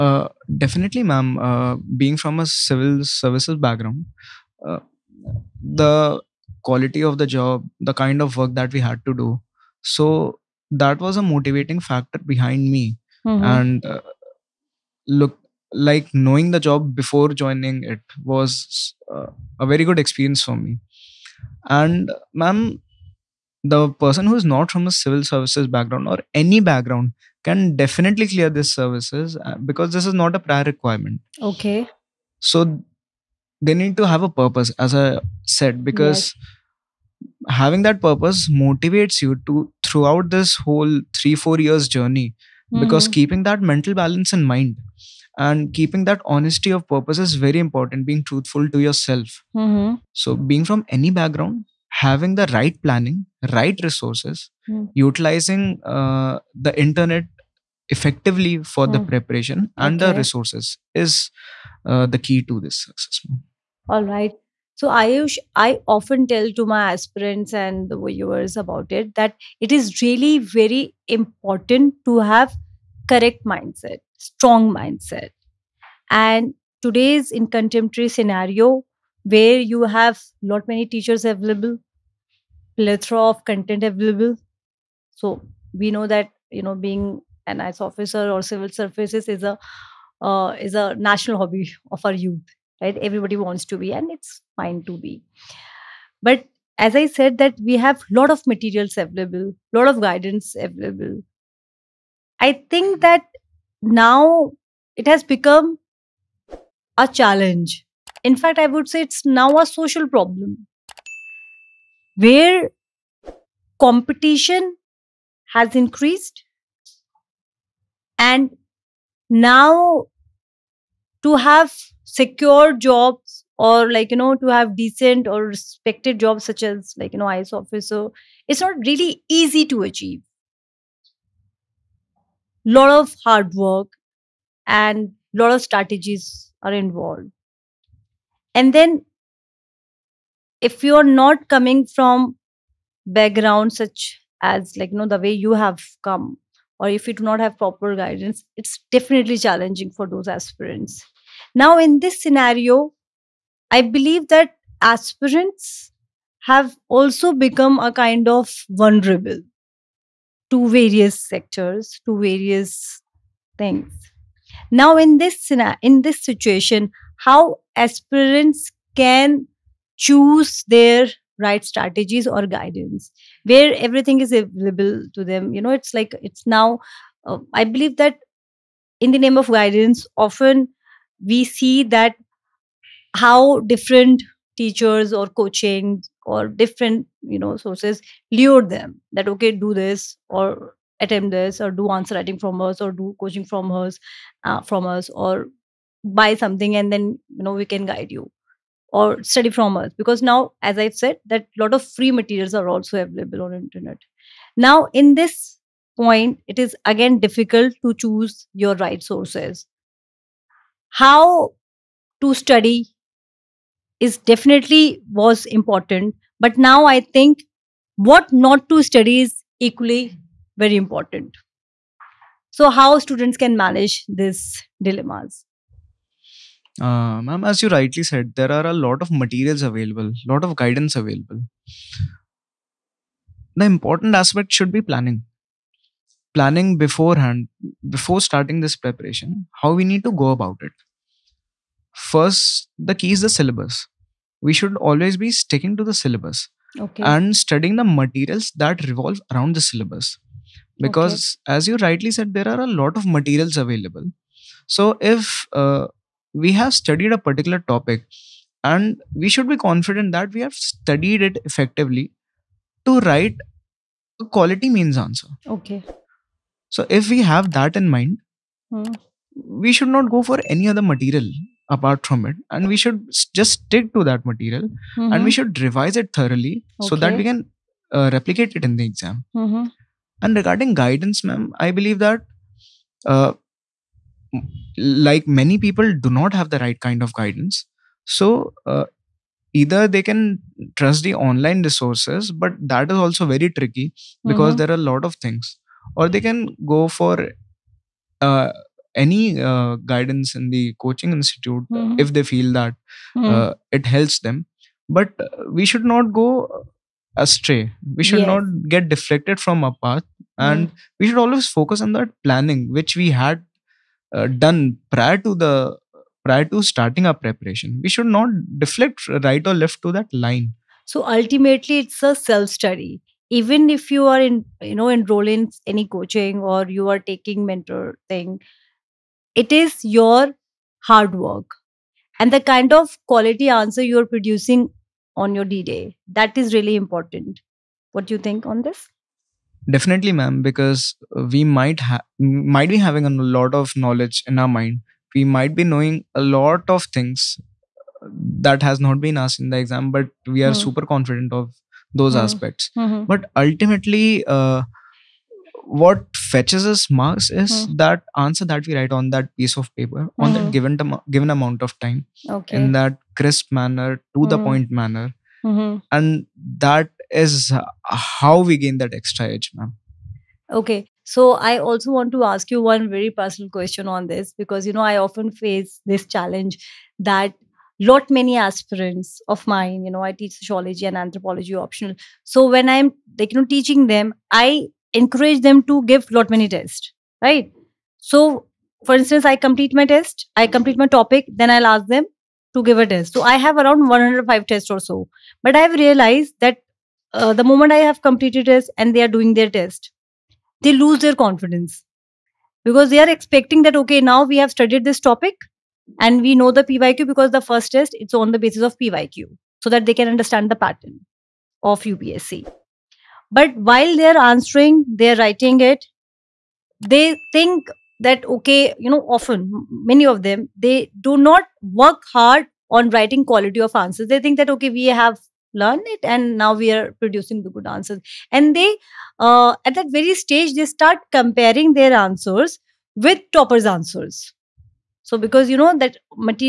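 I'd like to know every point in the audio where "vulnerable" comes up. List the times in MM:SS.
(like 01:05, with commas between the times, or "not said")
02:38.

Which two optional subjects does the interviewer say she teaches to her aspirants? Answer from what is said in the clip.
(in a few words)
sociology and anthropology.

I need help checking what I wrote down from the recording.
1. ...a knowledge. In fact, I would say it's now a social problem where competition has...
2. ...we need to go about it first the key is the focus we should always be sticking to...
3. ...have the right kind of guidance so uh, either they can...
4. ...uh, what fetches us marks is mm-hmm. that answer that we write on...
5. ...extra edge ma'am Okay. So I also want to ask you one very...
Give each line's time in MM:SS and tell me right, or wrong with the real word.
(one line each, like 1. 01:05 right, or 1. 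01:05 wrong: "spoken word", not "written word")
1. 01:47 wrong: "challenge", not "knowledge"
2. 03:59 wrong: "syllabus", not "focus"
3. 04:46 right
4. 05:54 right
5. 06:08 right.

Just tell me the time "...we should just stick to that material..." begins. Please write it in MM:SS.
04:32.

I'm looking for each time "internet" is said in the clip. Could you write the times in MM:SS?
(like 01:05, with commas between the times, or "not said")
00:56, 03:23.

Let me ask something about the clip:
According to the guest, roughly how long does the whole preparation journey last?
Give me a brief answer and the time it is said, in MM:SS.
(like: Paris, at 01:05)
3 4 years, at 00:41.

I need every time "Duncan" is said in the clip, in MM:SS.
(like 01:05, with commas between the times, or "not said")
not said.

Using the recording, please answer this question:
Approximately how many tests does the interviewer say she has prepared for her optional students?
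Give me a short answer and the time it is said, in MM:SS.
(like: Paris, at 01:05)
105, at 06:33.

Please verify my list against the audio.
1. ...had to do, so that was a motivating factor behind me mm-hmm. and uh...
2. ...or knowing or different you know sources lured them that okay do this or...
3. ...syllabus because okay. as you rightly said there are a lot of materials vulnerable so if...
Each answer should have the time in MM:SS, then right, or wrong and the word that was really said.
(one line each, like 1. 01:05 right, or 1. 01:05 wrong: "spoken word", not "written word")
1. 00:08 right
2. 03:05 wrong: "coaching", not "knowing"
3. 04:09 wrong: "available", not "vulnerable".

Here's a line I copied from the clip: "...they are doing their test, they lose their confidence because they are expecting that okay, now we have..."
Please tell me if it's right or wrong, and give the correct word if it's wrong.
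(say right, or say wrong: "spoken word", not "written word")
right.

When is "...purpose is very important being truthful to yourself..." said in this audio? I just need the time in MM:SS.
00:46.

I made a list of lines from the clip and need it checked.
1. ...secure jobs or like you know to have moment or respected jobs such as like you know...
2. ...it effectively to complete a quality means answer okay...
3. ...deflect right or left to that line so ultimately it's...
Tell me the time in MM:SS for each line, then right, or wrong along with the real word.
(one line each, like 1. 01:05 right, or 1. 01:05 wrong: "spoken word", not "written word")
1. 02:02 wrong: "decent", not "moment"
2. 04:21 wrong: "write", not "complete"
3. 05:18 right.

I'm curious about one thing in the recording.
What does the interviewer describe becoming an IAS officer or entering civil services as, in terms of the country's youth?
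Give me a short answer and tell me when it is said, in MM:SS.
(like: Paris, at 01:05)
national hobby, at 01:30.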